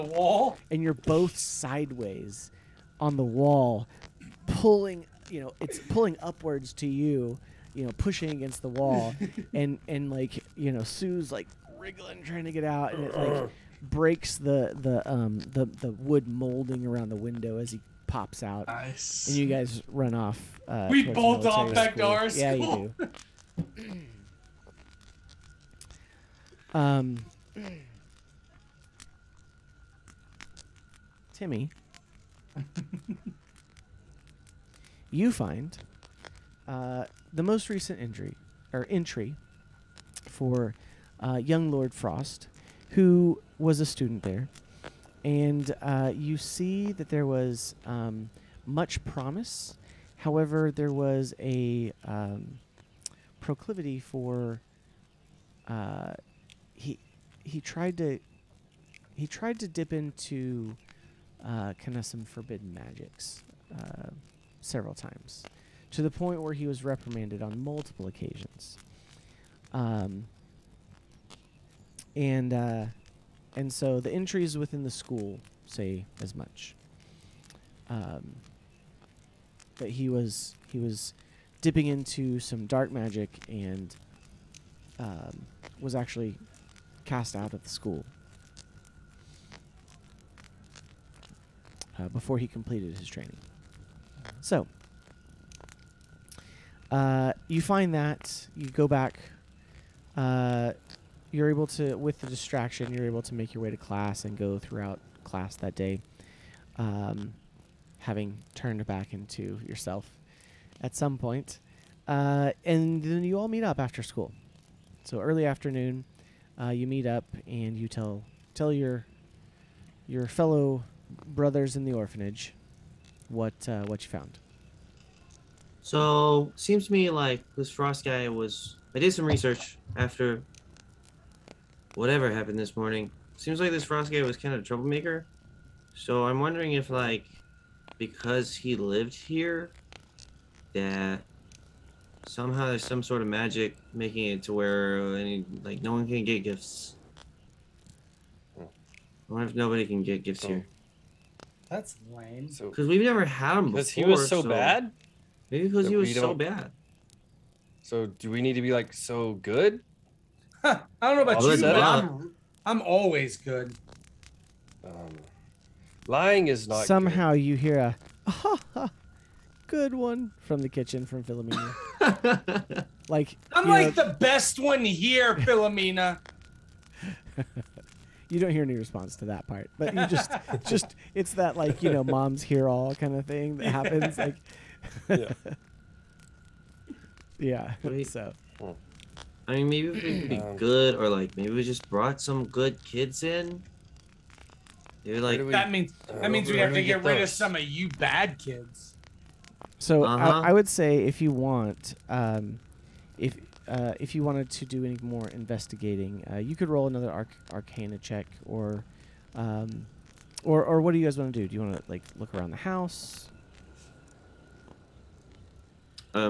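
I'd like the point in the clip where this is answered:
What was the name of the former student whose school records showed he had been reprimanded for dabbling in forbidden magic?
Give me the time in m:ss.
0:41.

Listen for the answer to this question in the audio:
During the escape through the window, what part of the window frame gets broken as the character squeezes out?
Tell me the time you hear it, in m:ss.
0:15.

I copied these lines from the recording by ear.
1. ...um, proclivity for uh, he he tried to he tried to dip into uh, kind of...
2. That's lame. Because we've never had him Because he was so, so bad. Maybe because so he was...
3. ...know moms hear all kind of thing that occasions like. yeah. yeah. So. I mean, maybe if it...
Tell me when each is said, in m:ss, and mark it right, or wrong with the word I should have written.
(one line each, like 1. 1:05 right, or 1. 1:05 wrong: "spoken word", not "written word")
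1. 0:52 right
2. 2:31 right
3. 3:01 wrong: "happens", not "occasions".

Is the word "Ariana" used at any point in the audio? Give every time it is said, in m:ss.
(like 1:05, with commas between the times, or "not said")
not said.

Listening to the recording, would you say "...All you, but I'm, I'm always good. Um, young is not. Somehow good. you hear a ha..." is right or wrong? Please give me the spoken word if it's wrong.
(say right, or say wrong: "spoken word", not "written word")
wrong: "lying", not "young".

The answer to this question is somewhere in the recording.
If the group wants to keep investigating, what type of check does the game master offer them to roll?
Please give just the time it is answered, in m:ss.
3:27.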